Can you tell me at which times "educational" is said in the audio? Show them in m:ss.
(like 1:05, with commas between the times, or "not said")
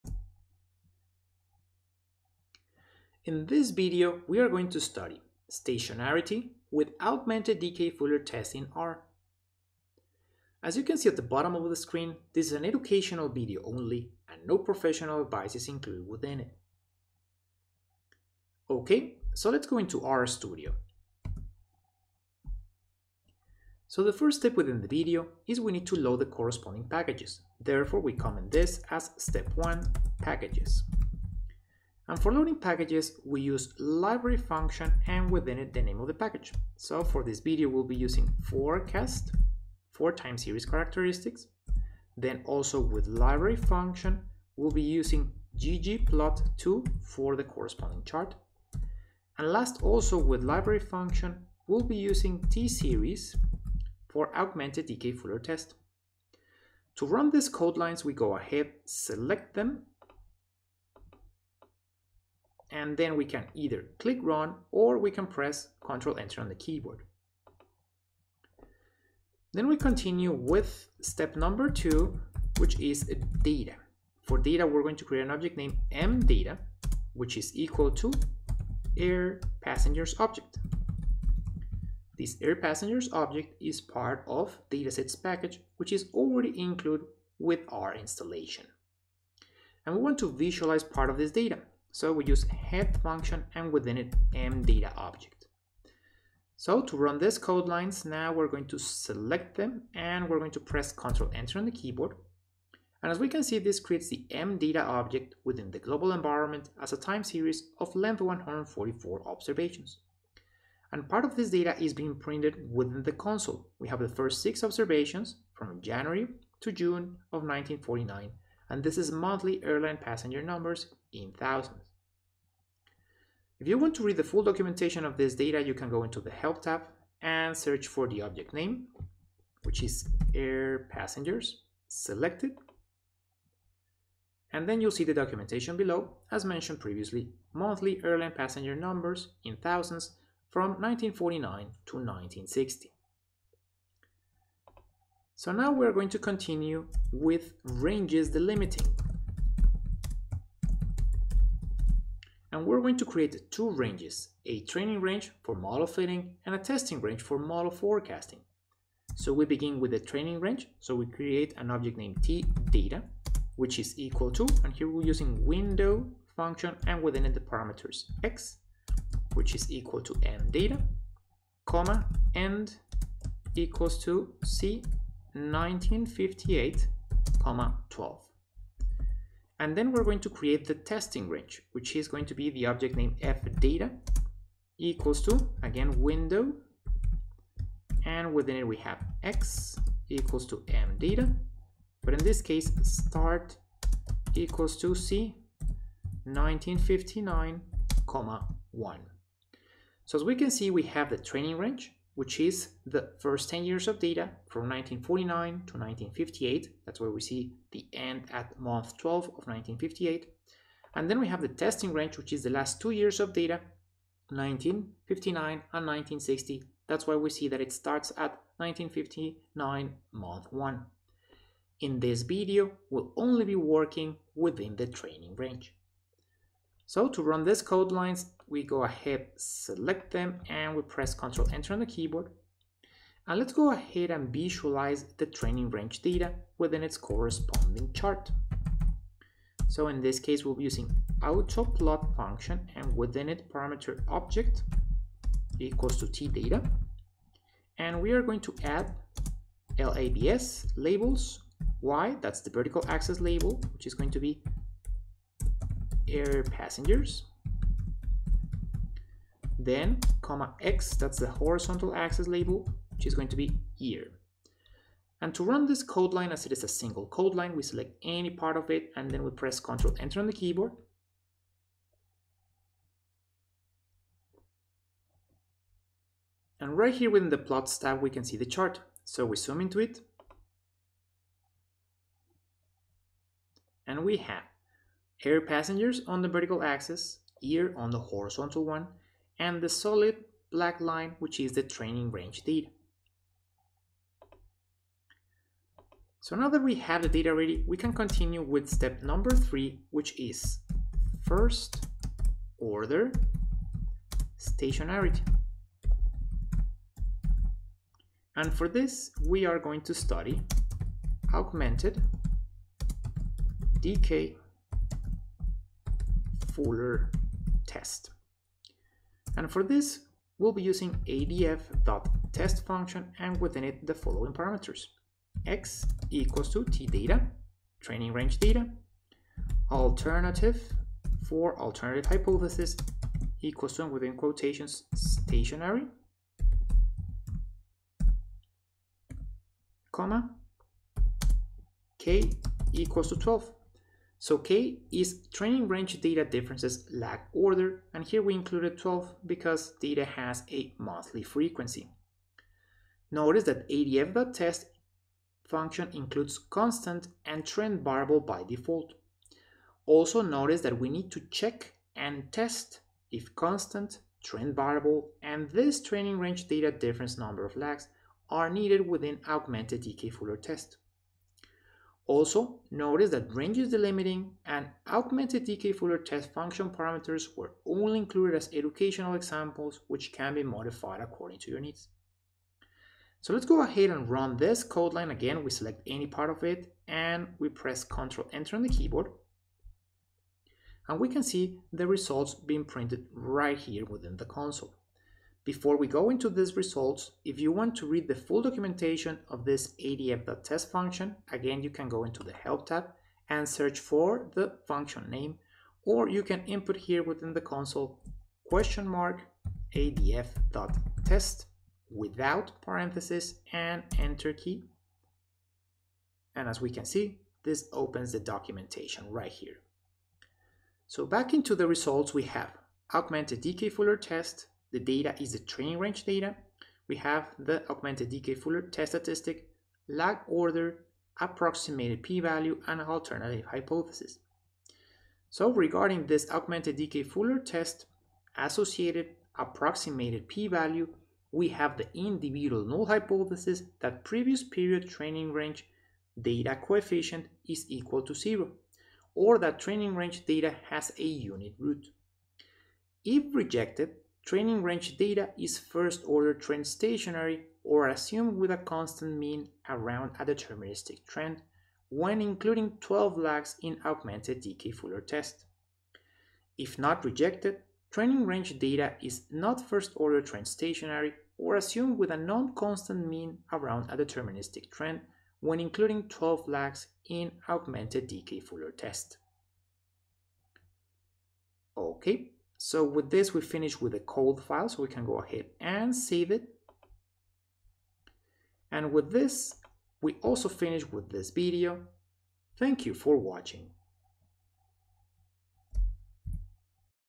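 0:12, 6:18.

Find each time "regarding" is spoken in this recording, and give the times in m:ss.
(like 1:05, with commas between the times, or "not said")
7:15.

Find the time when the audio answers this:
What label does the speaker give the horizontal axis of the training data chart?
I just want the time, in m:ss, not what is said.
4:23.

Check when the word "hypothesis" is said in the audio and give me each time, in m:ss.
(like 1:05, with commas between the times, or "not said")
5:32, 7:13, 7:22.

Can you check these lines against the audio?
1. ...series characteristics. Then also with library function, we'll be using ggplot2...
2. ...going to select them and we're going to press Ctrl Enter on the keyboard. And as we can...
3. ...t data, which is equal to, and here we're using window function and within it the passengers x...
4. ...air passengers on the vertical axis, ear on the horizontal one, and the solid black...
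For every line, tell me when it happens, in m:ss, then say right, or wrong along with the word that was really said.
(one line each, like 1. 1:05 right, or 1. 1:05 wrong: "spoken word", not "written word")
1. 0:40 right
2. 1:38 right
3. 2:42 wrong: "parameters", not "passengers"
4. 4:45 right.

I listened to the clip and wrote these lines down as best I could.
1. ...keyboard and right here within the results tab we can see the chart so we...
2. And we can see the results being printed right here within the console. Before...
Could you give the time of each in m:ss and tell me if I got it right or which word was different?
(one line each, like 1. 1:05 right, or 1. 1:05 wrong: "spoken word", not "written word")
1. 4:30 wrong: "plots", not "results"
2. 6:30 right.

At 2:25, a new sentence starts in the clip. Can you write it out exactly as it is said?
So now we're going to continue with ranges delimiting.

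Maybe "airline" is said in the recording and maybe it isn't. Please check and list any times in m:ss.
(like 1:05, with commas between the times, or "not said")
1:59, 2:18.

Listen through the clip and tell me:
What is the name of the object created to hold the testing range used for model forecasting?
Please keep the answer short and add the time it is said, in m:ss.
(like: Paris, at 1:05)
fdata, at 3:03.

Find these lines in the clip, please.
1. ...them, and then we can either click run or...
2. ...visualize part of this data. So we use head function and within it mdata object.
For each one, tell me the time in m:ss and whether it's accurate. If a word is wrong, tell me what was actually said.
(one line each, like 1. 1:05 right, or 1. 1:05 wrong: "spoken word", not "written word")
1. 0:59 right
2. 1:30 right.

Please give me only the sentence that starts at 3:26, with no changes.
That's where we see the end at month 12 of 1958.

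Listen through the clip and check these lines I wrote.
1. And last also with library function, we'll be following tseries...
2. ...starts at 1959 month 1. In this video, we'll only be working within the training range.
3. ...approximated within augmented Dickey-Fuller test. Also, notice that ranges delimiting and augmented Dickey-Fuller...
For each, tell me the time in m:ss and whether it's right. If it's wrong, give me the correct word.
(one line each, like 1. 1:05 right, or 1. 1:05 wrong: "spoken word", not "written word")
1. 0:49 wrong: "using", not "following"
2. 3:37 right
3. 6:08 wrong: "needed", not "approximated".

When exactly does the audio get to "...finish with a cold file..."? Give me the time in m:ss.
8:03.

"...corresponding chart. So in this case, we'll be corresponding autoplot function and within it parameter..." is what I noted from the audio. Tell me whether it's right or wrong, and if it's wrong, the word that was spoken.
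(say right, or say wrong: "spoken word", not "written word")
wrong: "using", not "corresponding".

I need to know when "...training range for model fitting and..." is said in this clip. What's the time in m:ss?
2:34.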